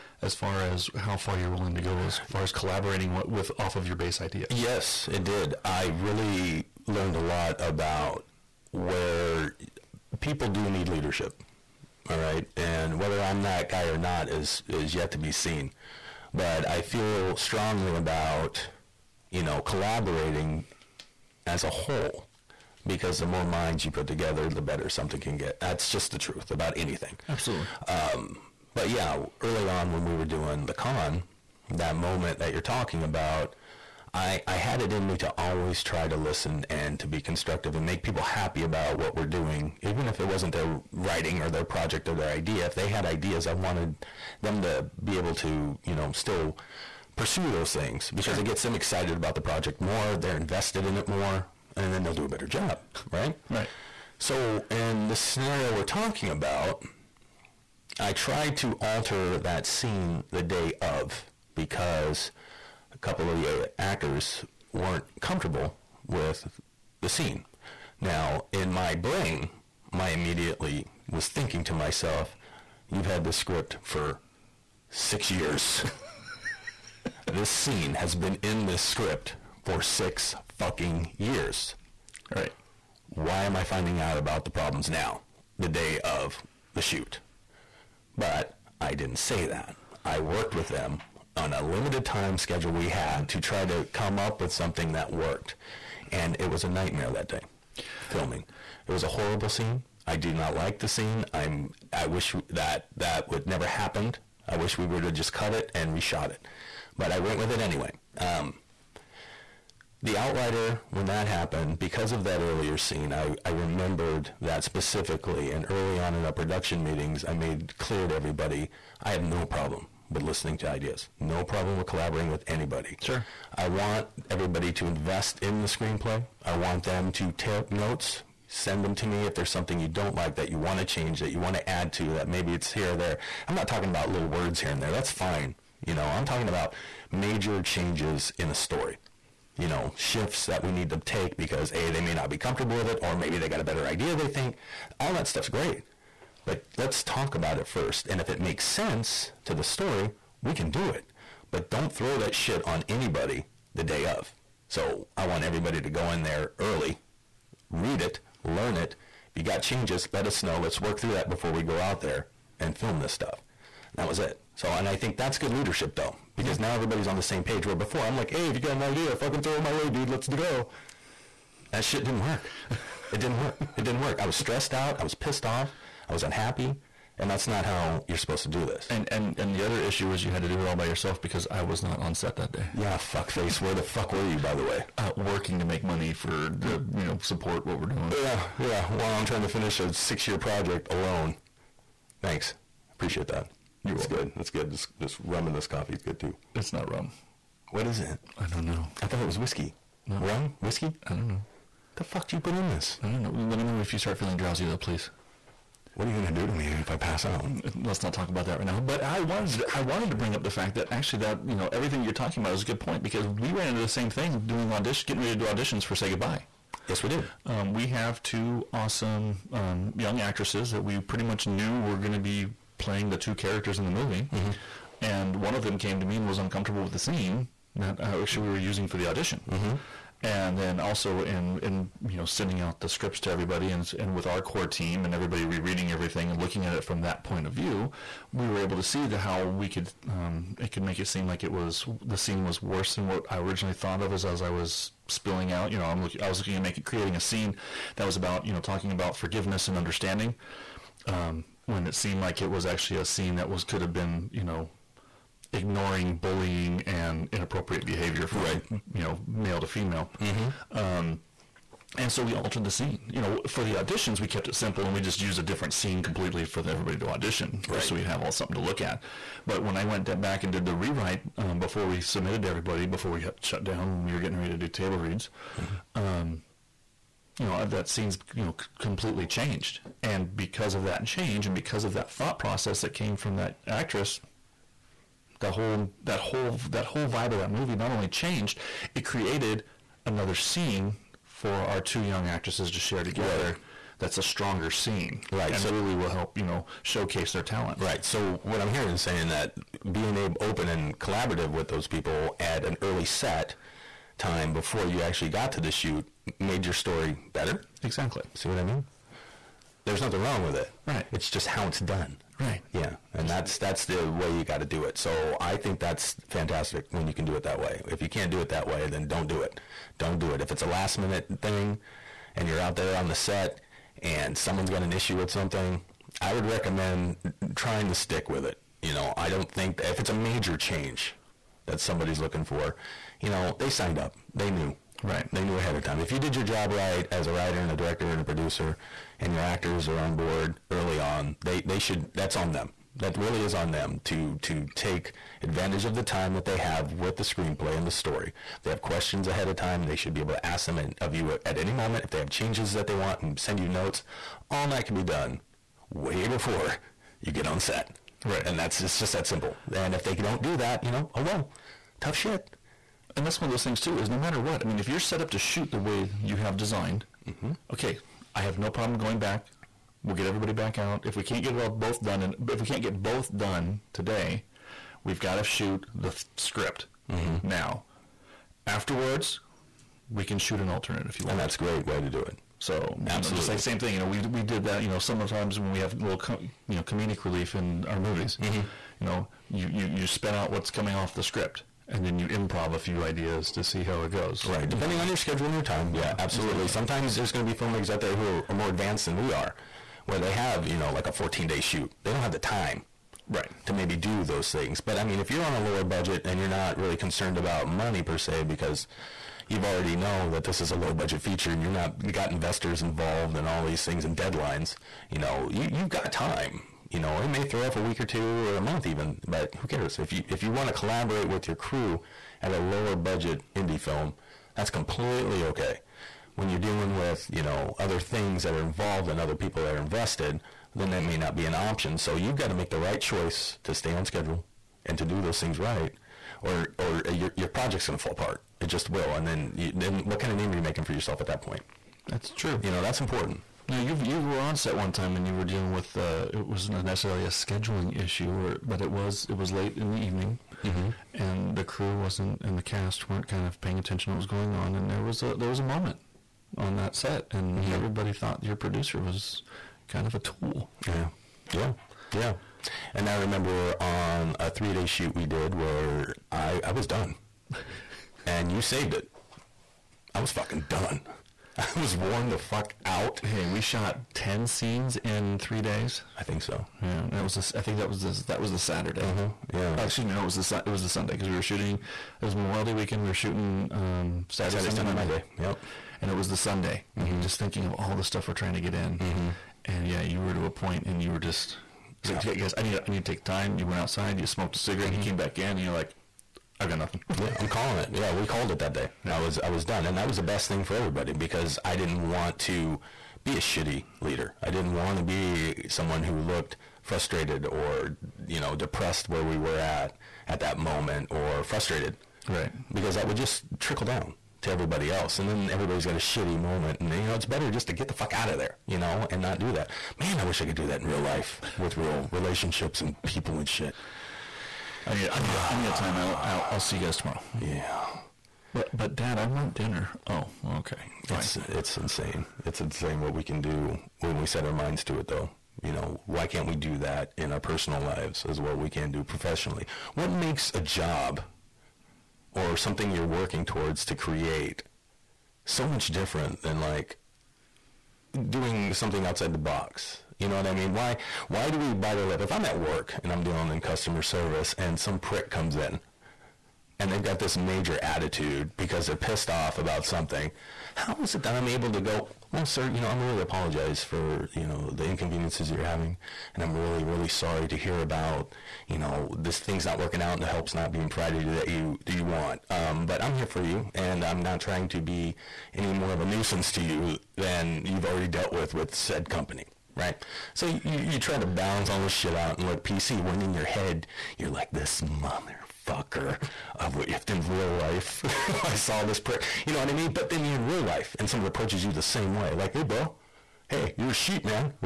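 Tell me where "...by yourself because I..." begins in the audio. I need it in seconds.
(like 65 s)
180 s.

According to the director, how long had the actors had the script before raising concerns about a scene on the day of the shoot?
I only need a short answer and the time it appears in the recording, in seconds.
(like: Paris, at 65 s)
6 years, at 74 s.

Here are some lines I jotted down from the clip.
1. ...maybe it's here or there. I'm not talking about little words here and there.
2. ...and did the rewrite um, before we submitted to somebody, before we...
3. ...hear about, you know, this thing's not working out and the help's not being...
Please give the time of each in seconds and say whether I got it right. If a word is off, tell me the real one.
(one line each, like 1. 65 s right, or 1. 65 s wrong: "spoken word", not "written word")
1. 132 s right
2. 270 s wrong: "everybody", not "somebody"
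3. 567 s right.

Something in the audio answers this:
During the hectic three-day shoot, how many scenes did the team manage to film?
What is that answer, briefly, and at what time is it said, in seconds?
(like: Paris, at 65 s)
10, at 474 s.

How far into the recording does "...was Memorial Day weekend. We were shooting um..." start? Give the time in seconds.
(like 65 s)
482 s.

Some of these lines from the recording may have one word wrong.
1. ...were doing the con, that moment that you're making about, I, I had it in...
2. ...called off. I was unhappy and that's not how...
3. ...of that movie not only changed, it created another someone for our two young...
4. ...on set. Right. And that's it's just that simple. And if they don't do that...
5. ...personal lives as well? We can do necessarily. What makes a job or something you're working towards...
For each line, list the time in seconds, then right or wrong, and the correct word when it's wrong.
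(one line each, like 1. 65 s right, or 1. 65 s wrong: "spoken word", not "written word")
1. 30 s wrong: "talking", not "making"
2. 175 s wrong: "pissed", not "called"
3. 287 s wrong: "scene", not "someone"
4. 357 s right
5. 537 s wrong: "professionally", not "necessarily".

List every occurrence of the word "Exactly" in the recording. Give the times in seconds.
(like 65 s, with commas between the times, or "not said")
307 s, 396 s.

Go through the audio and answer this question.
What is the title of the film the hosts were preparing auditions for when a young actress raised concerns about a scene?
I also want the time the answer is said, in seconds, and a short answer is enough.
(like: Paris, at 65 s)
Say Goodbye, at 215 s.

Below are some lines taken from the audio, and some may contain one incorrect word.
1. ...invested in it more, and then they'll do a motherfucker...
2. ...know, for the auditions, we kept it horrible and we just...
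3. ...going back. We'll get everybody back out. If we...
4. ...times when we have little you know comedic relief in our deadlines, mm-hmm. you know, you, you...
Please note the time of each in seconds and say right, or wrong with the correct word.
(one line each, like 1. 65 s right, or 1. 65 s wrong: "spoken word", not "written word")
1. 50 s wrong: "better", not "motherfucker"
2. 263 s wrong: "simple", not "horrible"
3. 368 s right
4. 385 s wrong: "movies", not "deadlines".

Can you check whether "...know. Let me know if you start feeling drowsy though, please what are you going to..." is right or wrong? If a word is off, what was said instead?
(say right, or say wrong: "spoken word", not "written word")
right.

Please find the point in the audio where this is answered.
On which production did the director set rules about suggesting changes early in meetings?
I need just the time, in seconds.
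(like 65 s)
110 s.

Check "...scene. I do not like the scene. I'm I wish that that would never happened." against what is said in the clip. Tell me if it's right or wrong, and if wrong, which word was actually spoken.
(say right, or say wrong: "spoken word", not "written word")
right.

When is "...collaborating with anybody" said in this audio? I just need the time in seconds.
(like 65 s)
121 s.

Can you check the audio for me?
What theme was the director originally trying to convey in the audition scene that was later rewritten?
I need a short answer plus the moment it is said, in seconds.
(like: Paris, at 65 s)
forgiveness and understanding, at 249 s.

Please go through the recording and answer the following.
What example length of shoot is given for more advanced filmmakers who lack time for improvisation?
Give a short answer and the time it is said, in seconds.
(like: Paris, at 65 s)
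14 days, at 401 s.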